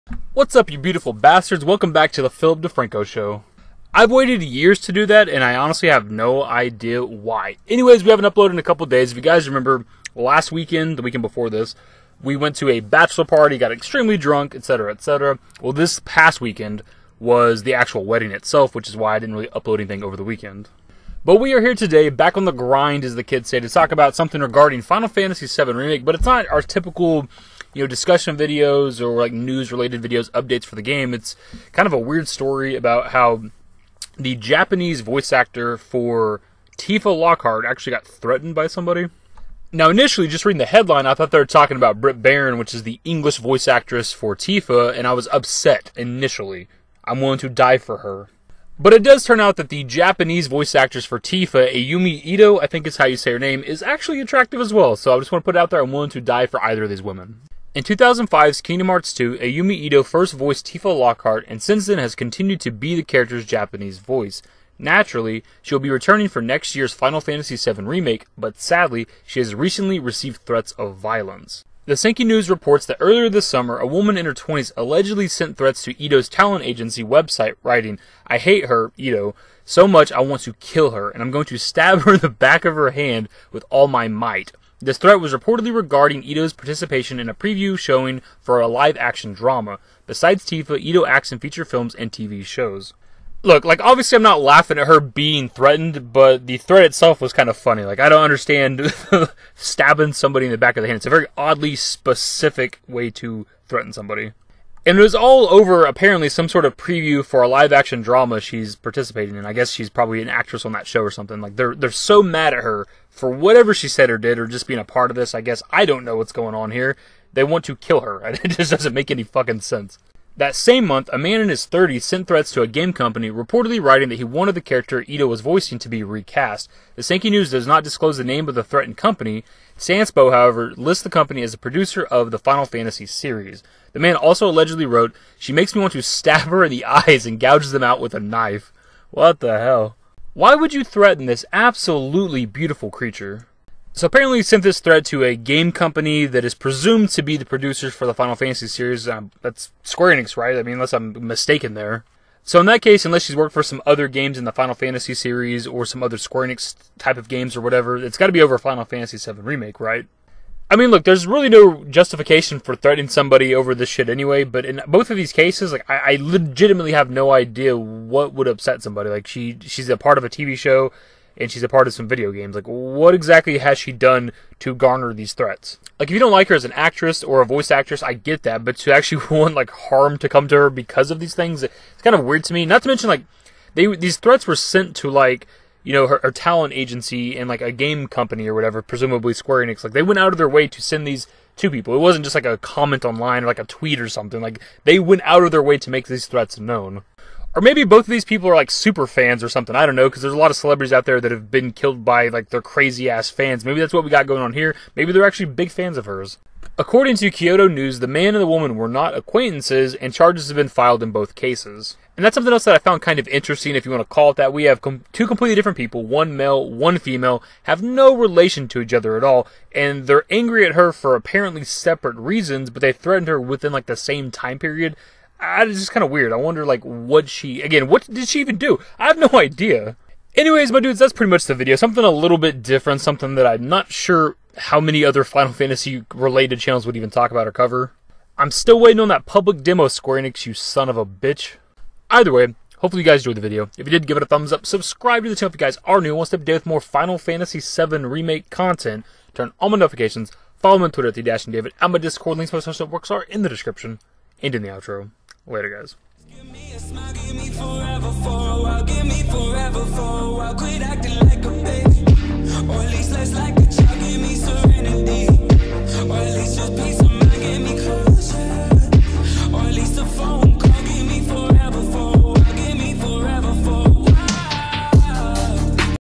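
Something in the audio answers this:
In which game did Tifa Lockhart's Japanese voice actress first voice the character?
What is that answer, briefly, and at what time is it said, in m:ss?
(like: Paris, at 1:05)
Kingdom Hearts 2, at 0:58.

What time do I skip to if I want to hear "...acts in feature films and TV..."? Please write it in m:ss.
1:31.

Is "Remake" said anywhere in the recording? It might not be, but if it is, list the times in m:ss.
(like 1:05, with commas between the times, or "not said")
0:25, 1:07, 2:39, 4:07.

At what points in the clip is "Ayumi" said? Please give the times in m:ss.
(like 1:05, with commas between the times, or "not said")
0:51, 0:59.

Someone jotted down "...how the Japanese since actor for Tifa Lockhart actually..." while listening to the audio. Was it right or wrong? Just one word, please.
wrong.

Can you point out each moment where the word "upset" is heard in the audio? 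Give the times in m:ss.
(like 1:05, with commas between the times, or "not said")
0:45, 2:48.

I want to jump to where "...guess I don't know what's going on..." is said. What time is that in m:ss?
1:55.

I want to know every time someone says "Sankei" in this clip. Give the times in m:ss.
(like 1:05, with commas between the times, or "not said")
1:11, 2:07.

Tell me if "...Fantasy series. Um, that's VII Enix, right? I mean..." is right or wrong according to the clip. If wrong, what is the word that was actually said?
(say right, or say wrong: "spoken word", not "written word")
wrong: "Square", not "VII".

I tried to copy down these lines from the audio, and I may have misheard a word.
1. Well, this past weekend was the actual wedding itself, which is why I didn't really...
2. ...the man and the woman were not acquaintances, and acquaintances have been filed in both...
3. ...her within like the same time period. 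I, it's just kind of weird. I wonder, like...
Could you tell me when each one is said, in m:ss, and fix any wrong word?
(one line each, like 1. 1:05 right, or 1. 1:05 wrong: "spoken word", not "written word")
1. 0:15 right
2. 3:27 wrong: "charges", not "acquaintances"
3. 3:43 right.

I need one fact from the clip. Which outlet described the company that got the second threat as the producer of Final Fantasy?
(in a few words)
Sanspo.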